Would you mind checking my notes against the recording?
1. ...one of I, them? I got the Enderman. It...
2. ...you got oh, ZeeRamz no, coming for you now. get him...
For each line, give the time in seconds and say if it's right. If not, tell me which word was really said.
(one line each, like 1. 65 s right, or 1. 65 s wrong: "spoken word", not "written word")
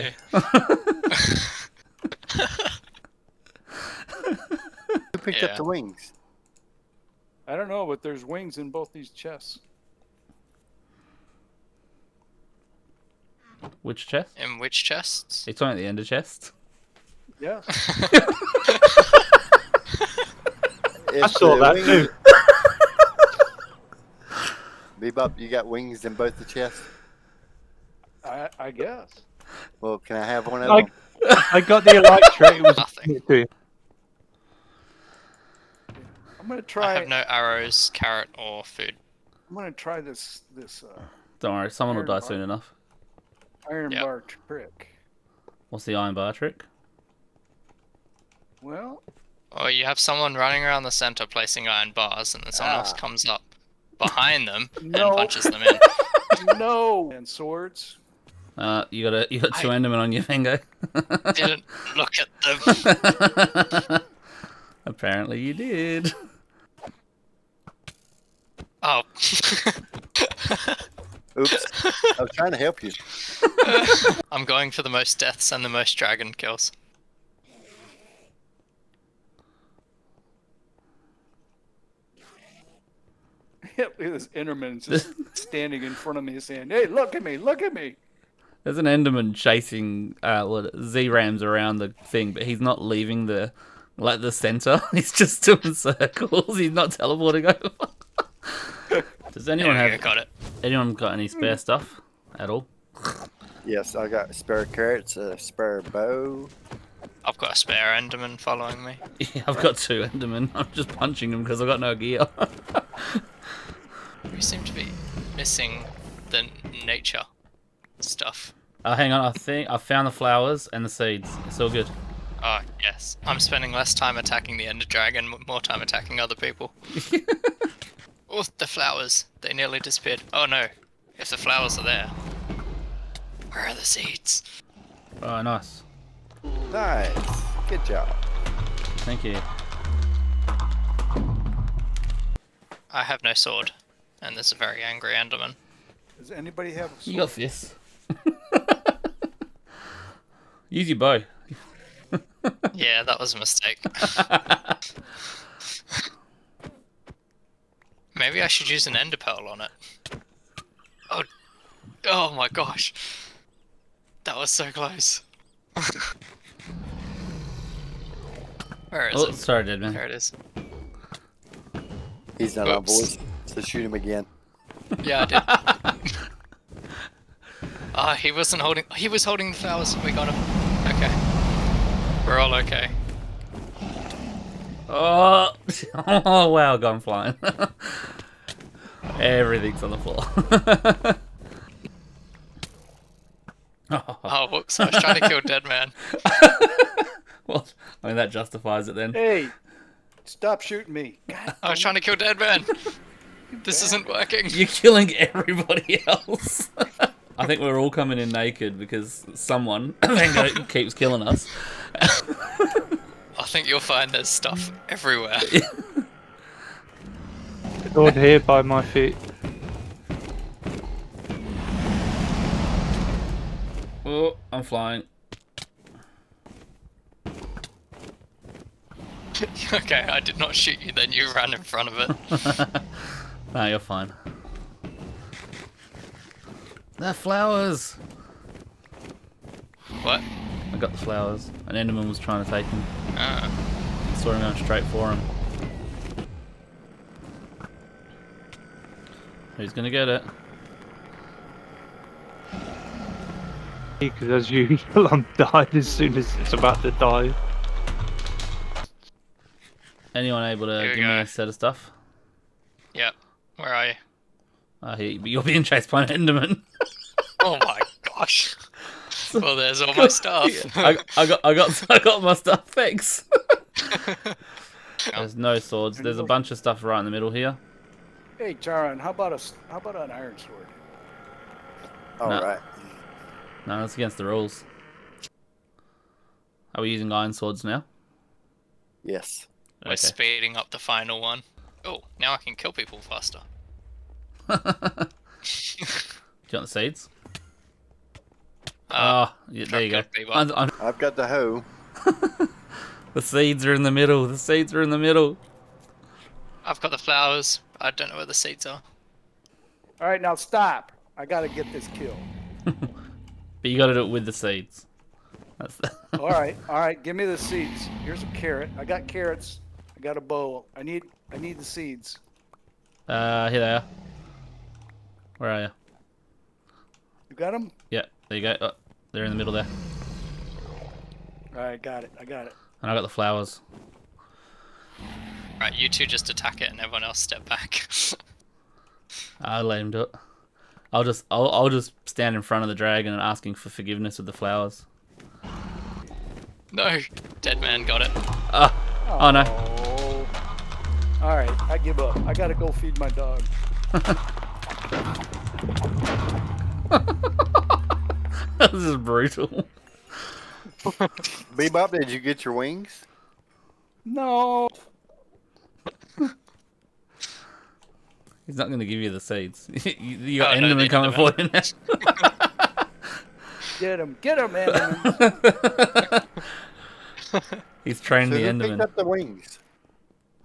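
1. 30 s wrong: "Elytra", not "Enderman"
2. 370 s wrong: "Enderman", not "ZeeRamz".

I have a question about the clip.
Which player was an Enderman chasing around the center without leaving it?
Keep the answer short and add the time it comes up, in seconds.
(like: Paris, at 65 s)
ZeeRamz, at 90 s.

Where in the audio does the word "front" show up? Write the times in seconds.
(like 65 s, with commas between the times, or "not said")
85 s, 231 s, 342 s.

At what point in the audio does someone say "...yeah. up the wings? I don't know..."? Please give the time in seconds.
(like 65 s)
5 s.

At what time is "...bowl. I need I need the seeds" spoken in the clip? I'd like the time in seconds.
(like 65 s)
320 s.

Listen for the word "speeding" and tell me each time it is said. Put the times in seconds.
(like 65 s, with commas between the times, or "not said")
289 s.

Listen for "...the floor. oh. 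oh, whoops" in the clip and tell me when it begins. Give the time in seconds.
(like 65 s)
189 s.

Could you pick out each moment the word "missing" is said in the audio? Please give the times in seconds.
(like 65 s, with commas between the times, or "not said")
115 s.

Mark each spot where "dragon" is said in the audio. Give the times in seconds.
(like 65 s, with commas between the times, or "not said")
75 s, 124 s, 342 s.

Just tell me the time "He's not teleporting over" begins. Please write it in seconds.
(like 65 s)
96 s.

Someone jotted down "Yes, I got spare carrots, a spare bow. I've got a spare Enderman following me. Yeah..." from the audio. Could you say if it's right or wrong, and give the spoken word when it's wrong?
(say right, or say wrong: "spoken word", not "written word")
right.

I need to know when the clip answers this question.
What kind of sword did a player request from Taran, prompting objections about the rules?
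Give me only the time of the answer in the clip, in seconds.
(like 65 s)
280 s.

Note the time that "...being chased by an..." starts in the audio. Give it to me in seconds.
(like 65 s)
265 s.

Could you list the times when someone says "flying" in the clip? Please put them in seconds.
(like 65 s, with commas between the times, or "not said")
187 s, 224 s.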